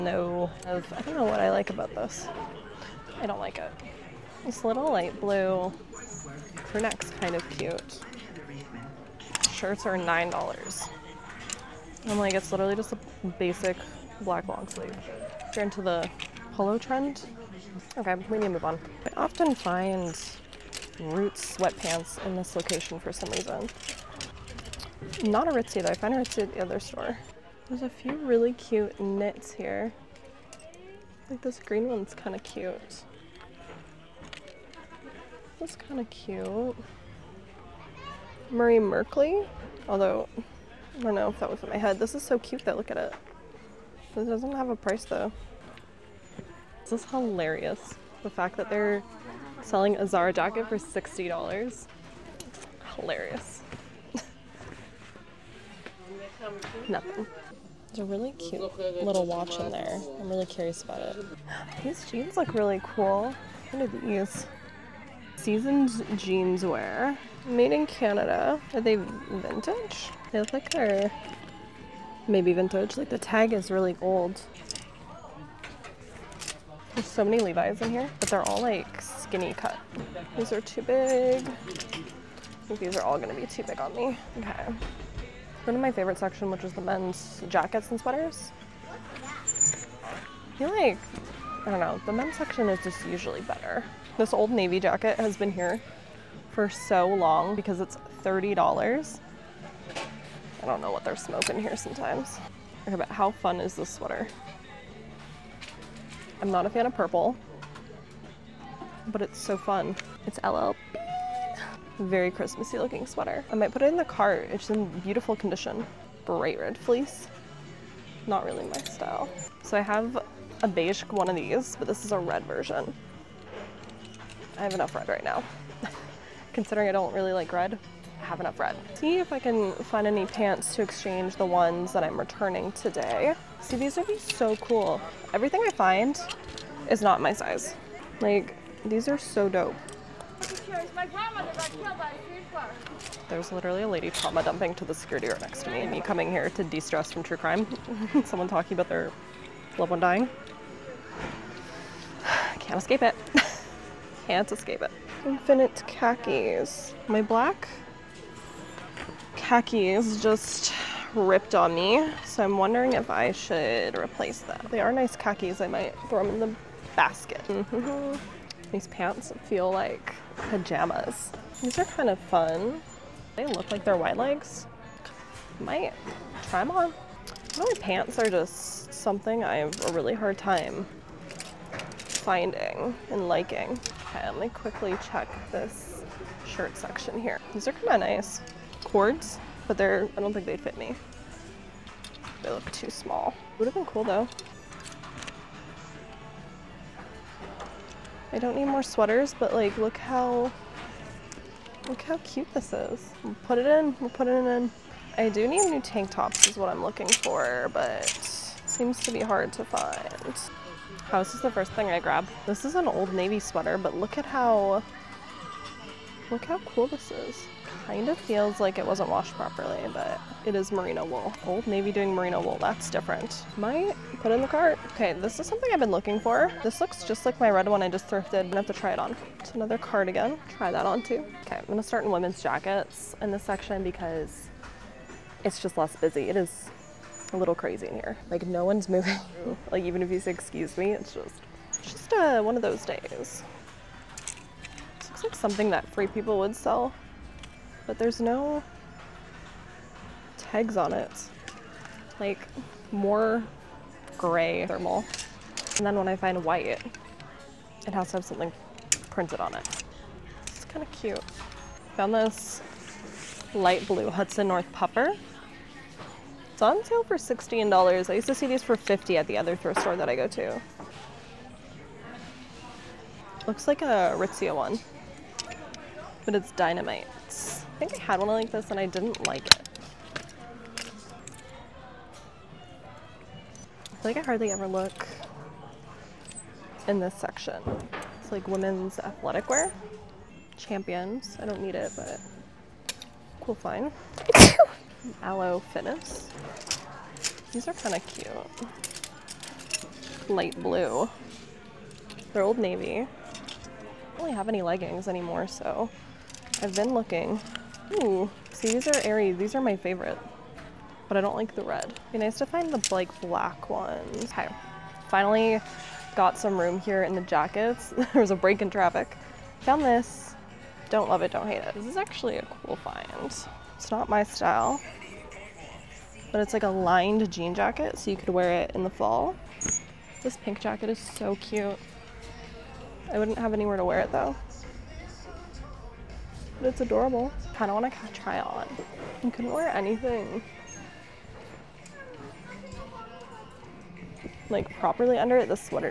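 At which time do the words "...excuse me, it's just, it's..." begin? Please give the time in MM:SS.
04:00.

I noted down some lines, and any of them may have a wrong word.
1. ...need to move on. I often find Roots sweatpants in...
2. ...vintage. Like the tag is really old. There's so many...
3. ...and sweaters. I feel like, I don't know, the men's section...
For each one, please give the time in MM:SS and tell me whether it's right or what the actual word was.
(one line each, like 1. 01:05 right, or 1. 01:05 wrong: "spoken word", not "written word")
1. 00:18 right
2. 01:12 right
3. 01:27 right.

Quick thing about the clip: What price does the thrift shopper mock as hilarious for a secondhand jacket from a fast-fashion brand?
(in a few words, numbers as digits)
$60.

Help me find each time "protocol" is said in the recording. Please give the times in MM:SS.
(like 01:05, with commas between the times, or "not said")
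not said.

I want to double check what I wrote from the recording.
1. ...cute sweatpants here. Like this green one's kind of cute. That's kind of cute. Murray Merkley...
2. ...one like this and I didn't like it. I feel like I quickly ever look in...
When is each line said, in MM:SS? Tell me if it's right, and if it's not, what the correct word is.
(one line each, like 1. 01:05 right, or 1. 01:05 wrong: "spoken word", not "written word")
1. 00:28 wrong: "knits", not "sweatpants"
2. 04:38 wrong: "hardly", not "quickly".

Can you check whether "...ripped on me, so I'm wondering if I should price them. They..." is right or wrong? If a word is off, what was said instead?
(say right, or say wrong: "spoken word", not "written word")
wrong: "replace", not "price".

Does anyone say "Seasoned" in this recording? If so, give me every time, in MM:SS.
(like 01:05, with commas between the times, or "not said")
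01:05.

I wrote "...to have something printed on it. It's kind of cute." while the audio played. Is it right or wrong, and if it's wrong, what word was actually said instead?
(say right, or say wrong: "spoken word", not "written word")
right.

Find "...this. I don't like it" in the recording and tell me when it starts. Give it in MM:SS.
00:01.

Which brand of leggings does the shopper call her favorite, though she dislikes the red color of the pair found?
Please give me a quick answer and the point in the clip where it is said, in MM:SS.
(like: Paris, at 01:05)
Aerie, at 05:09.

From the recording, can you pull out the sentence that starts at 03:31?
How is this the first thing I grab?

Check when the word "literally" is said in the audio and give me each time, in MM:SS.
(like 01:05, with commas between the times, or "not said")
00:12, 02:23.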